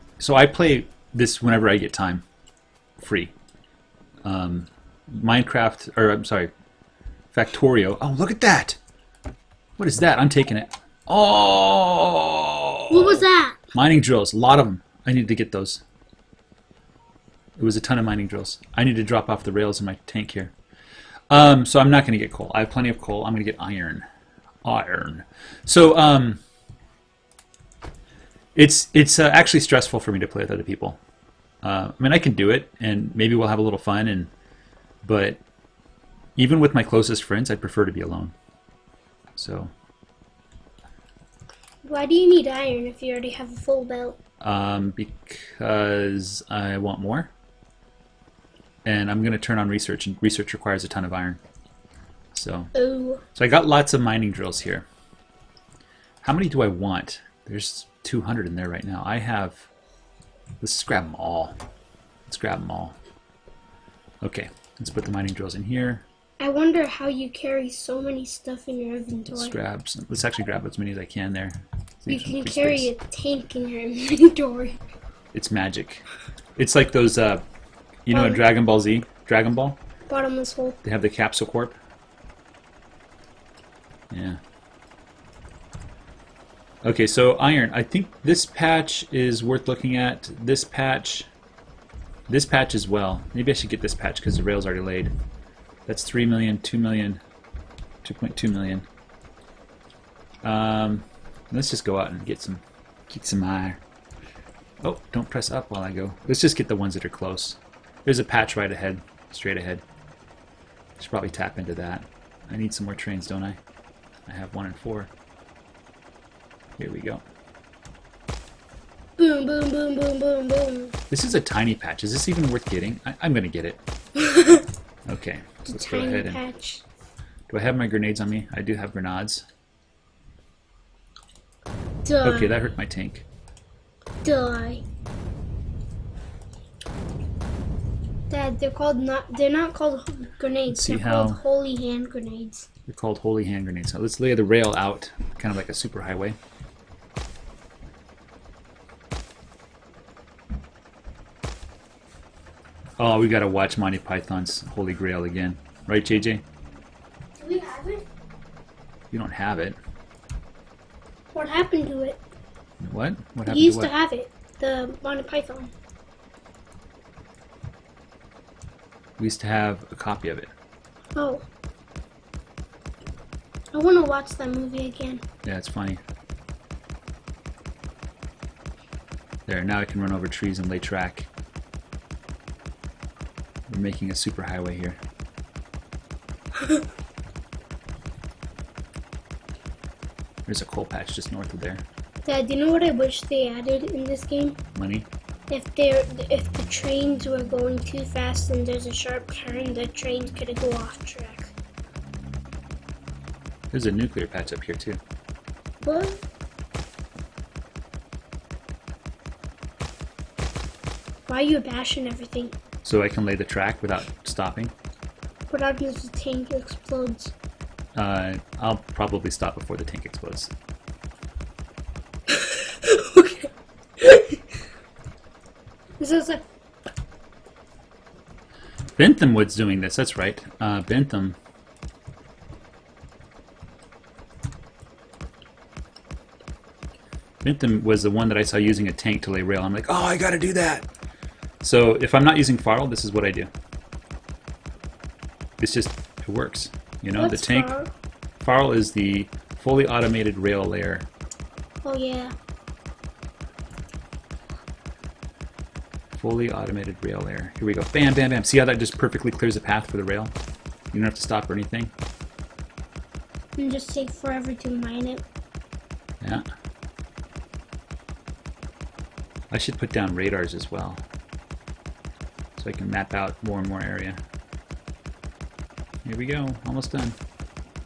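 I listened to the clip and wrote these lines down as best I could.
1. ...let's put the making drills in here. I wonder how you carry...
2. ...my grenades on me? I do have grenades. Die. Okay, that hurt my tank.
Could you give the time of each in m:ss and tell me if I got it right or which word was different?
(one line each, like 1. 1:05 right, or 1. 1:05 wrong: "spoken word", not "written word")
1. 1:04 wrong: "mining", not "making"
2. 2:07 right.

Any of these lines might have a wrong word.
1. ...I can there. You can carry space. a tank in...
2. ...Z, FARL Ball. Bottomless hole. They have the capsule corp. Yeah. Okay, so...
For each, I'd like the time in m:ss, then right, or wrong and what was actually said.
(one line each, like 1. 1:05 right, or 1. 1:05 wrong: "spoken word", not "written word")
1. 1:10 right
2. 1:18 wrong: "Dragon", not "FARL".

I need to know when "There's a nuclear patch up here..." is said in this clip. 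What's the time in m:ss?
3:23.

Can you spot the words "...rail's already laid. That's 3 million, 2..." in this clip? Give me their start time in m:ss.
1:34.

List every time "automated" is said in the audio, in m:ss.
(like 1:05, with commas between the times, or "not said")
4:09, 4:16.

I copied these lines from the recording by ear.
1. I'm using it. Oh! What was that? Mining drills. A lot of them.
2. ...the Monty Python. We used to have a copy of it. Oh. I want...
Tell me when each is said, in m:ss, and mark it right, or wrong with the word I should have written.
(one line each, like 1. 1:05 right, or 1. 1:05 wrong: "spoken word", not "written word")
1. 0:10 wrong: "taking", not "using"
2. 2:44 right.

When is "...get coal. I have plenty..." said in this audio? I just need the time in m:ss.
0:22.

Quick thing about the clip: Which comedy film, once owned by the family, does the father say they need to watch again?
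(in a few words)
Monty Python's Holy Grail.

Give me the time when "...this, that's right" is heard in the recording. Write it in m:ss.
3:49.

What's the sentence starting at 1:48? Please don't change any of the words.
There's a patch right ahead, straight ahead.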